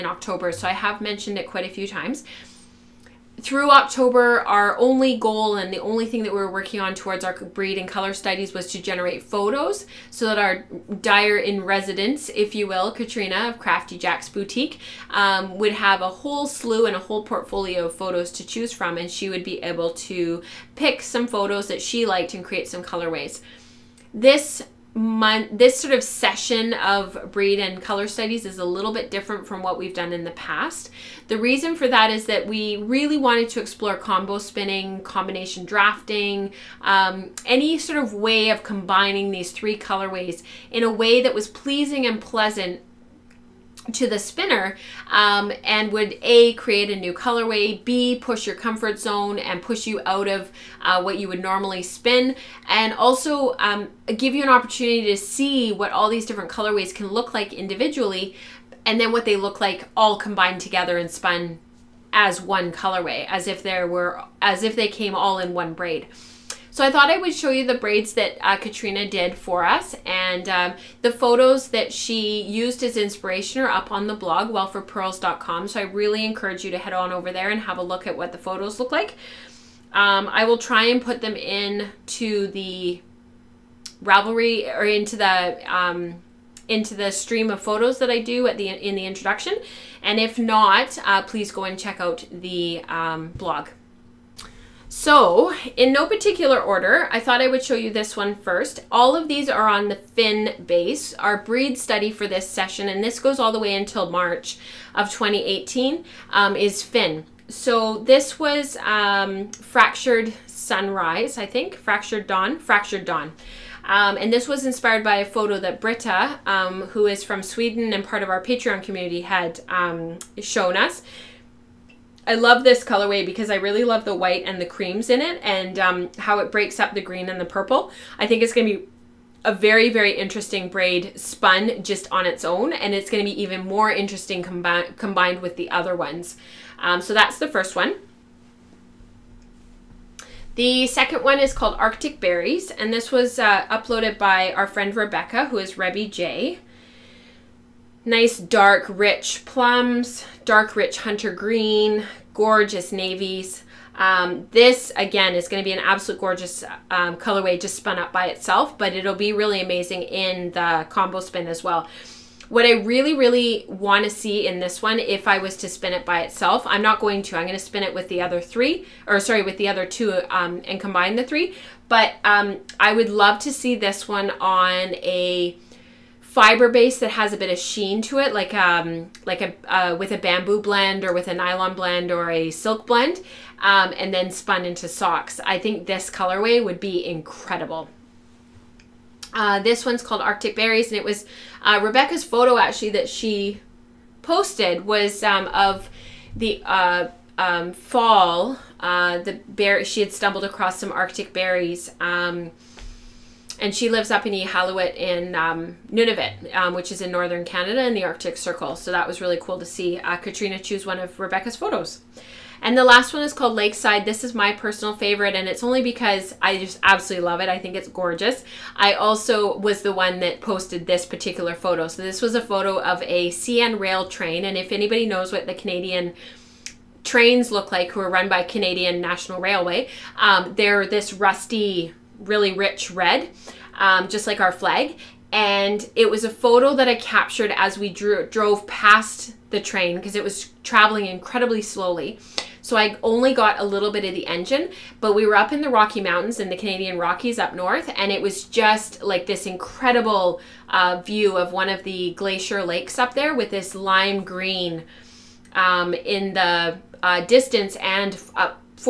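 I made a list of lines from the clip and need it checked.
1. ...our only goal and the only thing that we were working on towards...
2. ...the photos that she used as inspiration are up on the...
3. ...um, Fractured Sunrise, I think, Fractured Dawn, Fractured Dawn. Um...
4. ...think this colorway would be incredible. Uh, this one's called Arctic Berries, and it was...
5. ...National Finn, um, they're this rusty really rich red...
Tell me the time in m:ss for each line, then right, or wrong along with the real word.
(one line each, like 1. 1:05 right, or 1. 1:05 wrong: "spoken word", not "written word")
1. 0:04 right
2. 1:11 right
3. 1:48 right
4. 3:05 right
5. 3:49 wrong: "Railway", not "Finn".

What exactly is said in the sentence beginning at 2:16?
Um, so that's the first one.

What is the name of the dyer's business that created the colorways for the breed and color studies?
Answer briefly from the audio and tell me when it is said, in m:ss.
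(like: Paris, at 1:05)
Crafty Jack's Boutique, at 0:13.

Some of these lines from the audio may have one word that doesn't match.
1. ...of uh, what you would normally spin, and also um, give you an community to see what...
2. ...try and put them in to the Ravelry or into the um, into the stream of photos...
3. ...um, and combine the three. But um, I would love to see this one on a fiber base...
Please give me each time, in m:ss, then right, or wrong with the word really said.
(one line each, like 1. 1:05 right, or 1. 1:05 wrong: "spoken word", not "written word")
1. 0:50 wrong: "opportunity", not "community"
2. 1:20 right
3. 2:50 right.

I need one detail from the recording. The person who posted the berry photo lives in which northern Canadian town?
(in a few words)
Iqaluit.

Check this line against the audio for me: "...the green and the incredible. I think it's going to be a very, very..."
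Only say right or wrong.
wrong.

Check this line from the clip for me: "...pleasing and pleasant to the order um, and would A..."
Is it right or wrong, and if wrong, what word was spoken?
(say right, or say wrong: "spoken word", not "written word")
wrong: "spinner", not "order".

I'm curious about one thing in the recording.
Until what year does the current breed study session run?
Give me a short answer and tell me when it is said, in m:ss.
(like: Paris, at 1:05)
2018, at 1:45.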